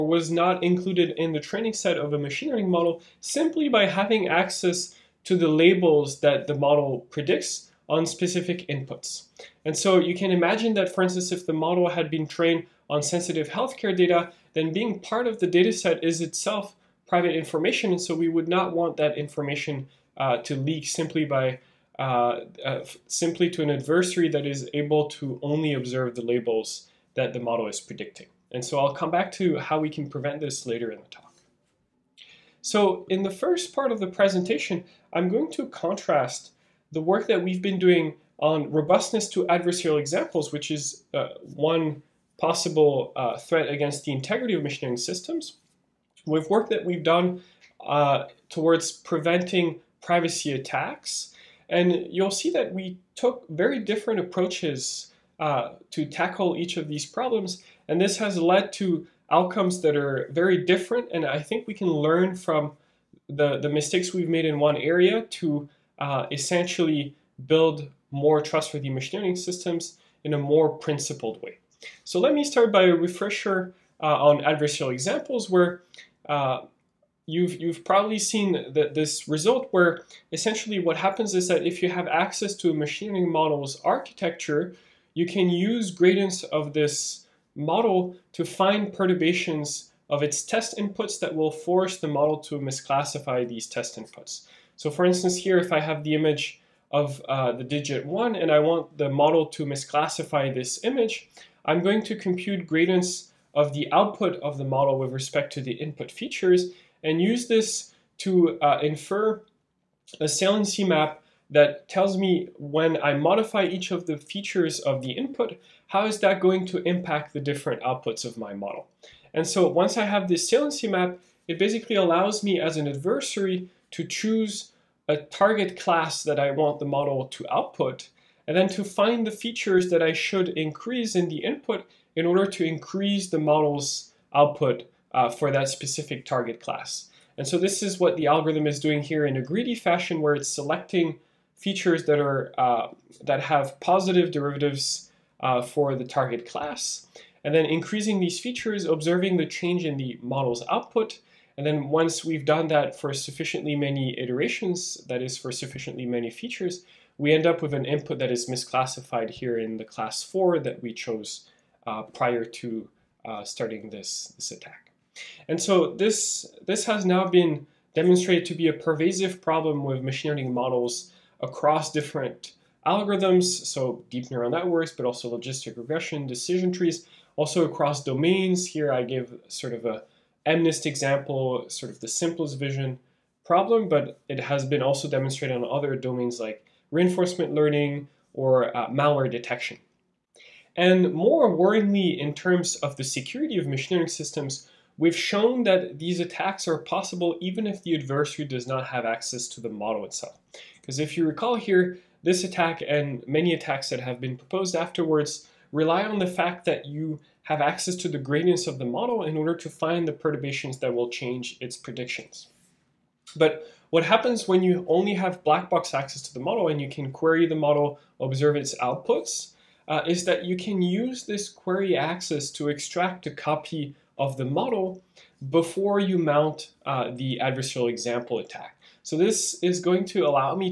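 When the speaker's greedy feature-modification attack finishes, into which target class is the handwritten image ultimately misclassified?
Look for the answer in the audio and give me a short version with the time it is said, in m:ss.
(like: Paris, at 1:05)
4, at 2:39.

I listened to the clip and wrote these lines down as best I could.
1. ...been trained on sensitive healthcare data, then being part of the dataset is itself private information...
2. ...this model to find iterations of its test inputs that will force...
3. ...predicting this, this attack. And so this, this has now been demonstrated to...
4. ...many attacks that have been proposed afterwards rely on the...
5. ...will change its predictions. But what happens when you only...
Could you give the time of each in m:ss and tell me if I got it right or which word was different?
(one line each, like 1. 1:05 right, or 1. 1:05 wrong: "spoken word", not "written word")
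1. 0:12 right
2. 1:26 wrong: "perturbations", not "iterations"
3. 2:43 wrong: "starting", not "predicting"
4. 3:23 right
5. 3:30 right.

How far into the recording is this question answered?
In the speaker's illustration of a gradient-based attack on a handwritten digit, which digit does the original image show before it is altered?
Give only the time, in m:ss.
1:37.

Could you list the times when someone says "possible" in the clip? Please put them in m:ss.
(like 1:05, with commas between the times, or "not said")
0:42, 3:16.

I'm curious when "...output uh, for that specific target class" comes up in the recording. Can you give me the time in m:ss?
2:14.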